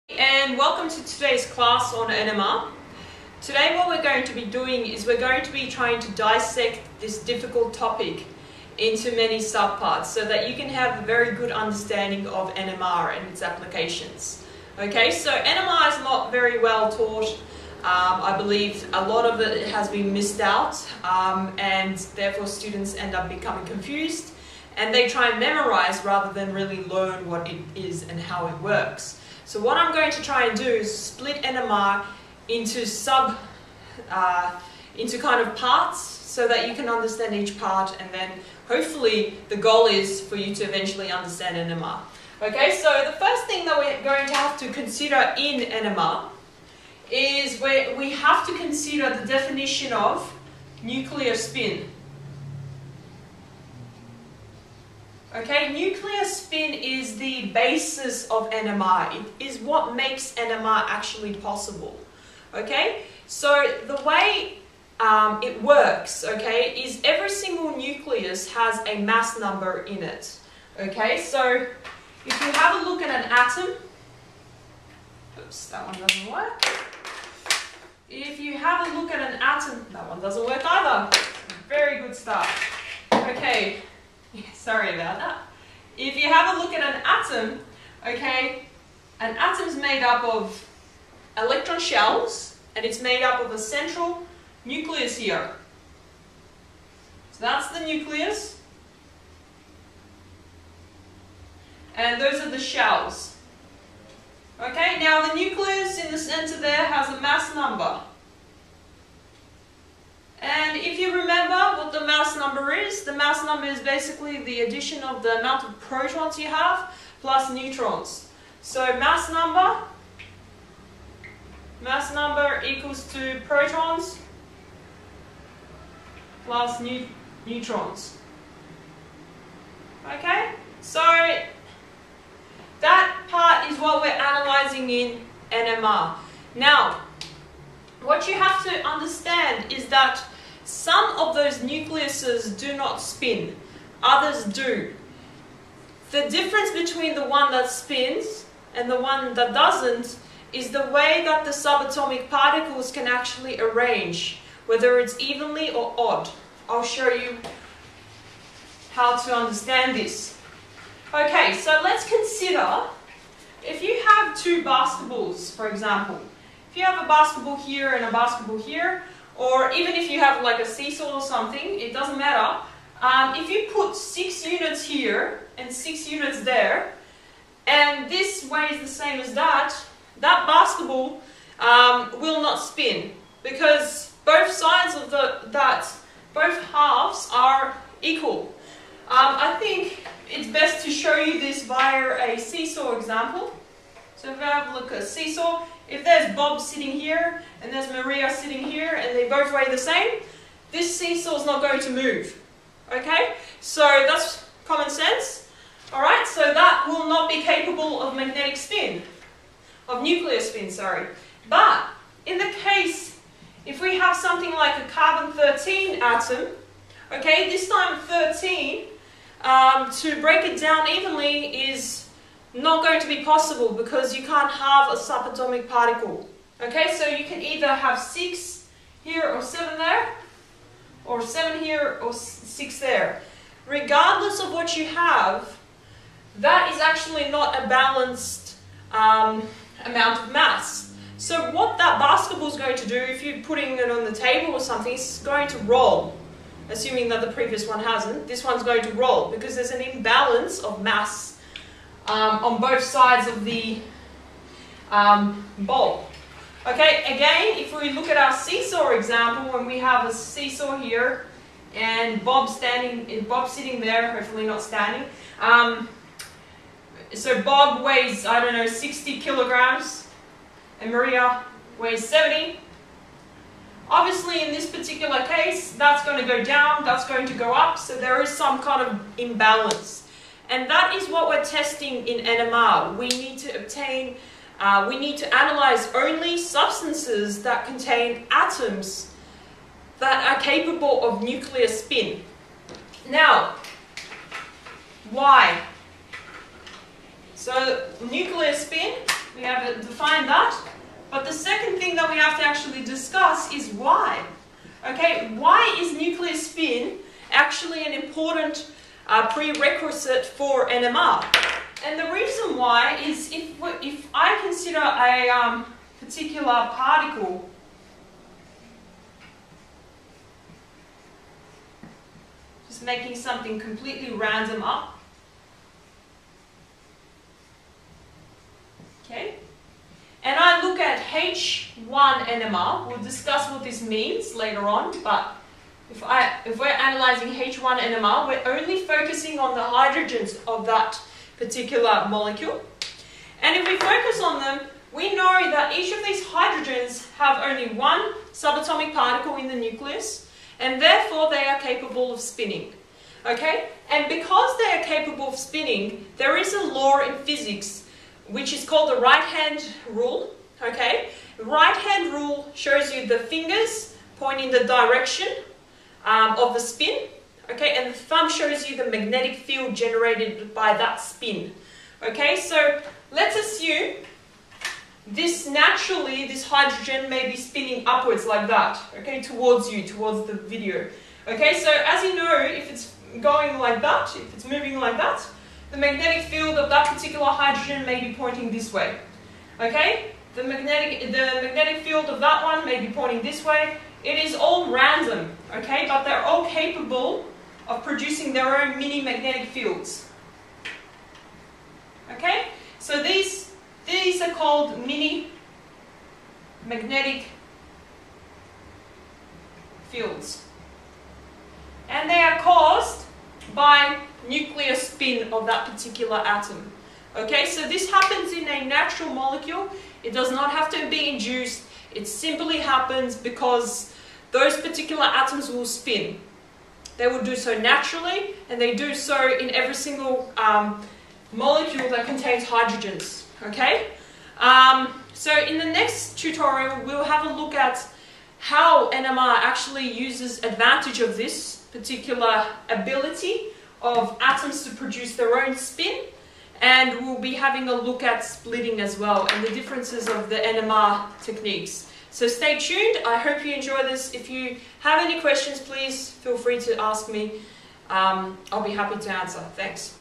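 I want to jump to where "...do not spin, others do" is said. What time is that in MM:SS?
02:22.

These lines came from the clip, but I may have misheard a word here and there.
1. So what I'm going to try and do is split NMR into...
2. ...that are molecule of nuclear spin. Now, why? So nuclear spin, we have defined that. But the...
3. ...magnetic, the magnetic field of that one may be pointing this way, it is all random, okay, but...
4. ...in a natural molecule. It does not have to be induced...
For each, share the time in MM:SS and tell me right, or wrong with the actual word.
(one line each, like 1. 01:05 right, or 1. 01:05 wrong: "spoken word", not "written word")
1. 00:29 right
2. 04:49 wrong: "capable", not "molecule"
3. 06:30 right
4. 06:58 right.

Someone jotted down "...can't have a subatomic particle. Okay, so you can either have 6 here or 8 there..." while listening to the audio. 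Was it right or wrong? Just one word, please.
wrong.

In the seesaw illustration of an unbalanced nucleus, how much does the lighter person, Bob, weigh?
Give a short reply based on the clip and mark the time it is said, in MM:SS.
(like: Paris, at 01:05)
60 kilograms, at 04:28.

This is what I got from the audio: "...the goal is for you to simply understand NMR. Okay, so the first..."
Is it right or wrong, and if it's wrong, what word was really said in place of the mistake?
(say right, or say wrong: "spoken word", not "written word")
wrong: "eventually", not "simply".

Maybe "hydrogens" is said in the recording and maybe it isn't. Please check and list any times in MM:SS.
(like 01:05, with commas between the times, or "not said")
05:39, 05:46, 06:16, 06:27, 07:12.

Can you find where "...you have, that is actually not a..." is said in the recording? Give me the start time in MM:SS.
03:54.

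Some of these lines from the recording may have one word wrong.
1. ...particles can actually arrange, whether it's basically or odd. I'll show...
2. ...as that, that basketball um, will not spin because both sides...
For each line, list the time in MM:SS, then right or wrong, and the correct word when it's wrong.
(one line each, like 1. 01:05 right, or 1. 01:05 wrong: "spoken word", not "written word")
1. 02:32 wrong: "evenly", not "basically"
2. 02:59 right.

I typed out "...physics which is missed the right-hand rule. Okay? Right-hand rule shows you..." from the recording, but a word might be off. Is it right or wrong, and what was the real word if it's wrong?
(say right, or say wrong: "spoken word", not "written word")
wrong: "called", not "missed".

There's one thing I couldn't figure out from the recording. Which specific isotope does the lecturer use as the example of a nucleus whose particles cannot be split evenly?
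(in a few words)
Carbon-13.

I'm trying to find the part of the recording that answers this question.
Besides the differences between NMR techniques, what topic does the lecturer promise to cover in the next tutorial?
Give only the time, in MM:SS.
07:28.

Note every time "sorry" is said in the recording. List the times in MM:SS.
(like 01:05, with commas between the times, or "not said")
01:24, 03:30.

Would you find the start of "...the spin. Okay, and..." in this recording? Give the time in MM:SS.
06:06.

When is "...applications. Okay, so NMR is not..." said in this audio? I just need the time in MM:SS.
00:13.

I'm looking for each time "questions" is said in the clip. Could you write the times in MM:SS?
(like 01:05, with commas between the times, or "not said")
07:35.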